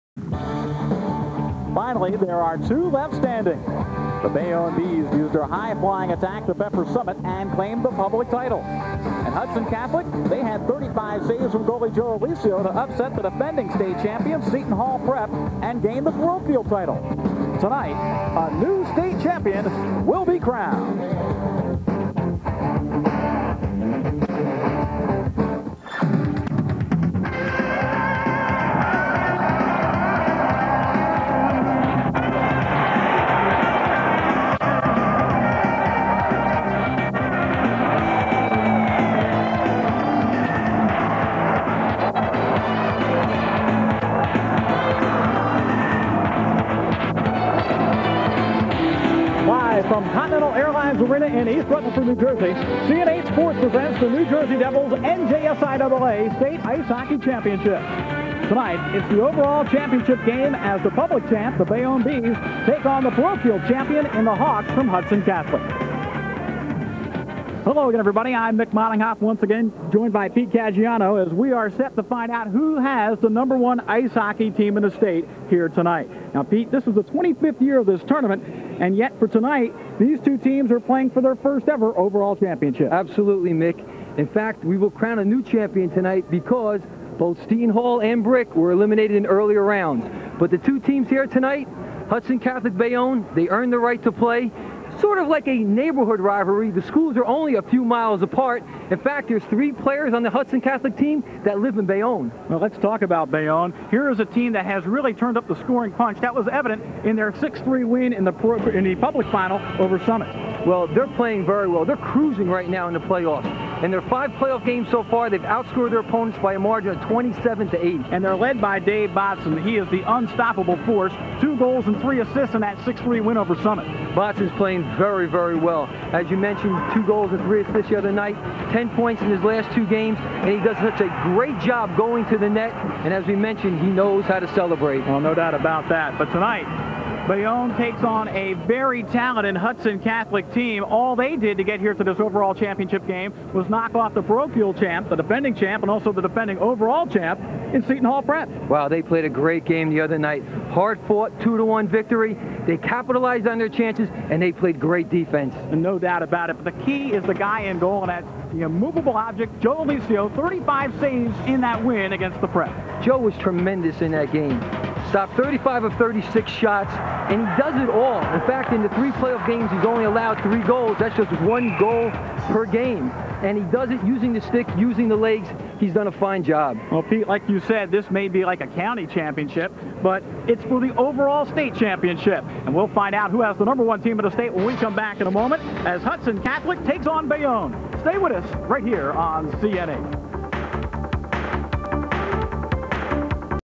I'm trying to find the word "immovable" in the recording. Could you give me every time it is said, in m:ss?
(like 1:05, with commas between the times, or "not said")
2:38.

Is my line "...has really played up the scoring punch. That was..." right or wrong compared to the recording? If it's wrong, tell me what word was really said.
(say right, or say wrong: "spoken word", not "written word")
wrong: "turned", not "played".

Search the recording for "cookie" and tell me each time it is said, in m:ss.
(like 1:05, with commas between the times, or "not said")
not said.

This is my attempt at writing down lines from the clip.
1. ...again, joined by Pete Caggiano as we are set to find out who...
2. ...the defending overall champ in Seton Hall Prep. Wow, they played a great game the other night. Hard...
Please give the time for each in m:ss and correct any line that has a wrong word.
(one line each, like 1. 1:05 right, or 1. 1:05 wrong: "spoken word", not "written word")
1. 1:09 right
2. 2:26 right.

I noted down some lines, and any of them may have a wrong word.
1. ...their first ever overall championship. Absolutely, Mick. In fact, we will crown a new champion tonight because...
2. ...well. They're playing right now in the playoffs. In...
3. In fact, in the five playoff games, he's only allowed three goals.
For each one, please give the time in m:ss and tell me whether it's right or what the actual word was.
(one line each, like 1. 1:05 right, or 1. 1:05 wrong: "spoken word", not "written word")
1. 1:21 right
2. 1:51 wrong: "cruising", not "playing"
3. 2:48 wrong: "three", not "five".